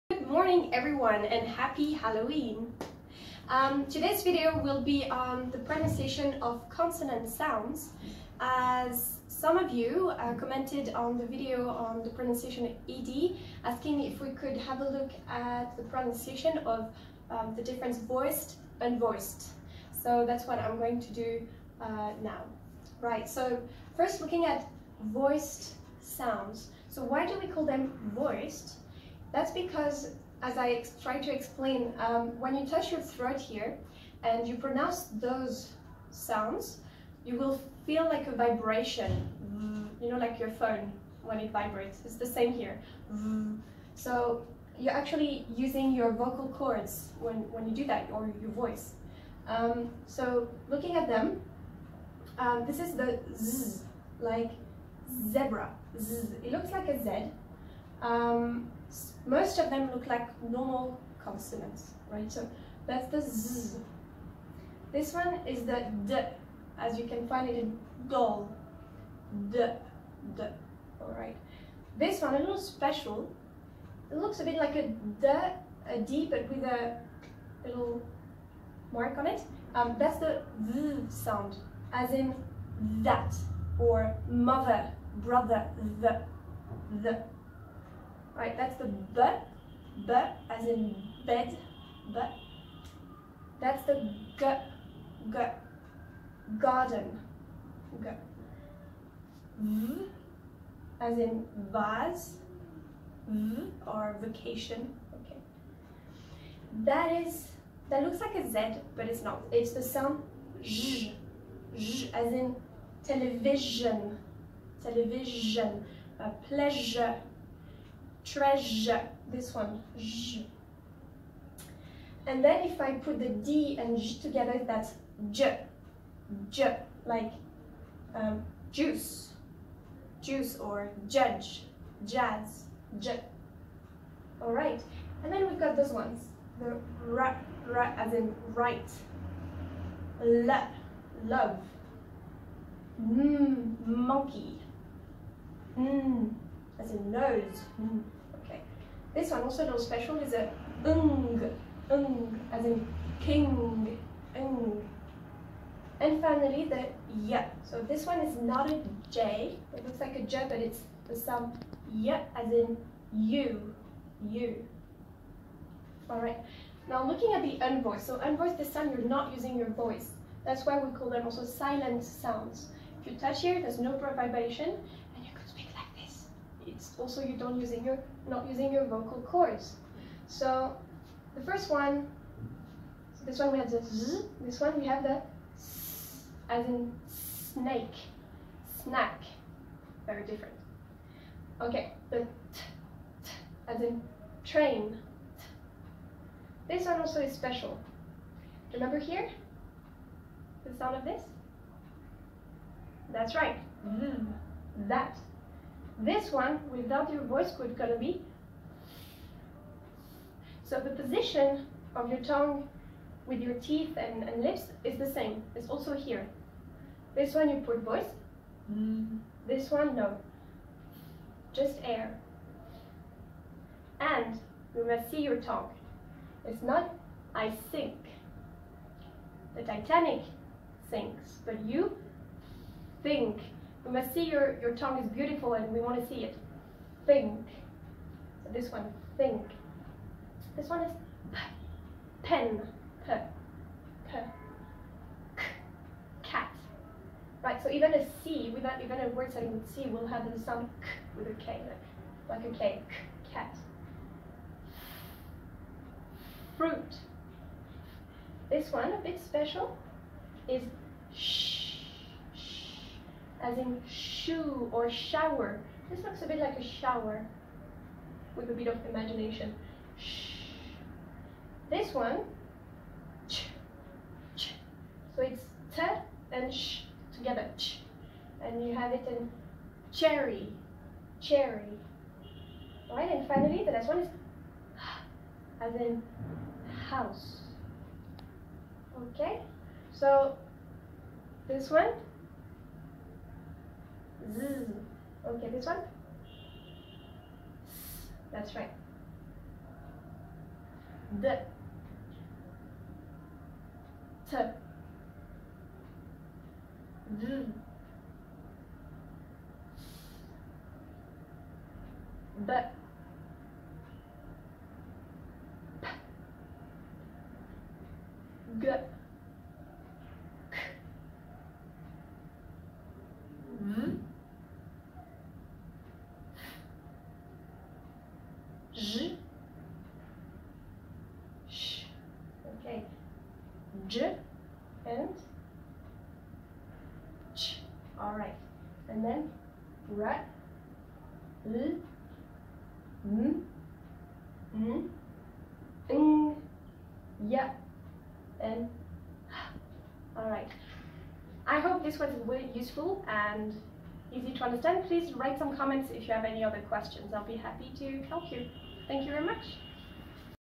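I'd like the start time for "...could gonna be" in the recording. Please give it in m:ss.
3:27.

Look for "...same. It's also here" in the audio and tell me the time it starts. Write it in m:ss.
3:35.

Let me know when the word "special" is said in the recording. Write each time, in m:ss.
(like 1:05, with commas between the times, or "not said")
1:12, 2:29, 3:17, 4:19.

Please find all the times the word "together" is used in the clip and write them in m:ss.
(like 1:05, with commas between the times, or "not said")
2:04, 4:37.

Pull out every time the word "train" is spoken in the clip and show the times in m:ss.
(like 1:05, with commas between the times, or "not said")
3:14.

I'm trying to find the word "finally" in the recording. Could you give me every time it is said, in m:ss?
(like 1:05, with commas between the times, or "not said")
2:36, 4:43.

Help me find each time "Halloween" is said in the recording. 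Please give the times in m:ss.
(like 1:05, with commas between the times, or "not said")
0:01.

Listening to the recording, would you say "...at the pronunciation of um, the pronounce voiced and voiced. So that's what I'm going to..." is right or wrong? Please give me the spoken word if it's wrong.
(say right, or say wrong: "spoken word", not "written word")
wrong: "difference", not "pronounce".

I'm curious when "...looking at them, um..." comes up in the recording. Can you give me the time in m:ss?
0:50.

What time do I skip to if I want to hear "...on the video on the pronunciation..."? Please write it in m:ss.
0:10.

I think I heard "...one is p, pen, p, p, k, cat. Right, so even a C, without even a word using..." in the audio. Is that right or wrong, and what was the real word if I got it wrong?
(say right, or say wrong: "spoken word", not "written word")
wrong: "starting", not "using".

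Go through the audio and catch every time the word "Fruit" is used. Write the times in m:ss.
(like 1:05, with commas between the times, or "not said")
4:16.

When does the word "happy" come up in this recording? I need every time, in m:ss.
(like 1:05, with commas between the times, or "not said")
0:01, 5:57.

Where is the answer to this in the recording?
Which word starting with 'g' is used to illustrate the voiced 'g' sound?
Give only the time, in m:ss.
1:36.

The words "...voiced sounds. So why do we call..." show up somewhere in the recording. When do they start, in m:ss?
0:25.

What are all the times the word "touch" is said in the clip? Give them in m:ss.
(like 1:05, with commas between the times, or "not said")
0:32, 2:53.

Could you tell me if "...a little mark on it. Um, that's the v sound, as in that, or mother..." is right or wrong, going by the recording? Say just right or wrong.
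right.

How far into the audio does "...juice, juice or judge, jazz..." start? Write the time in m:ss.
2:08.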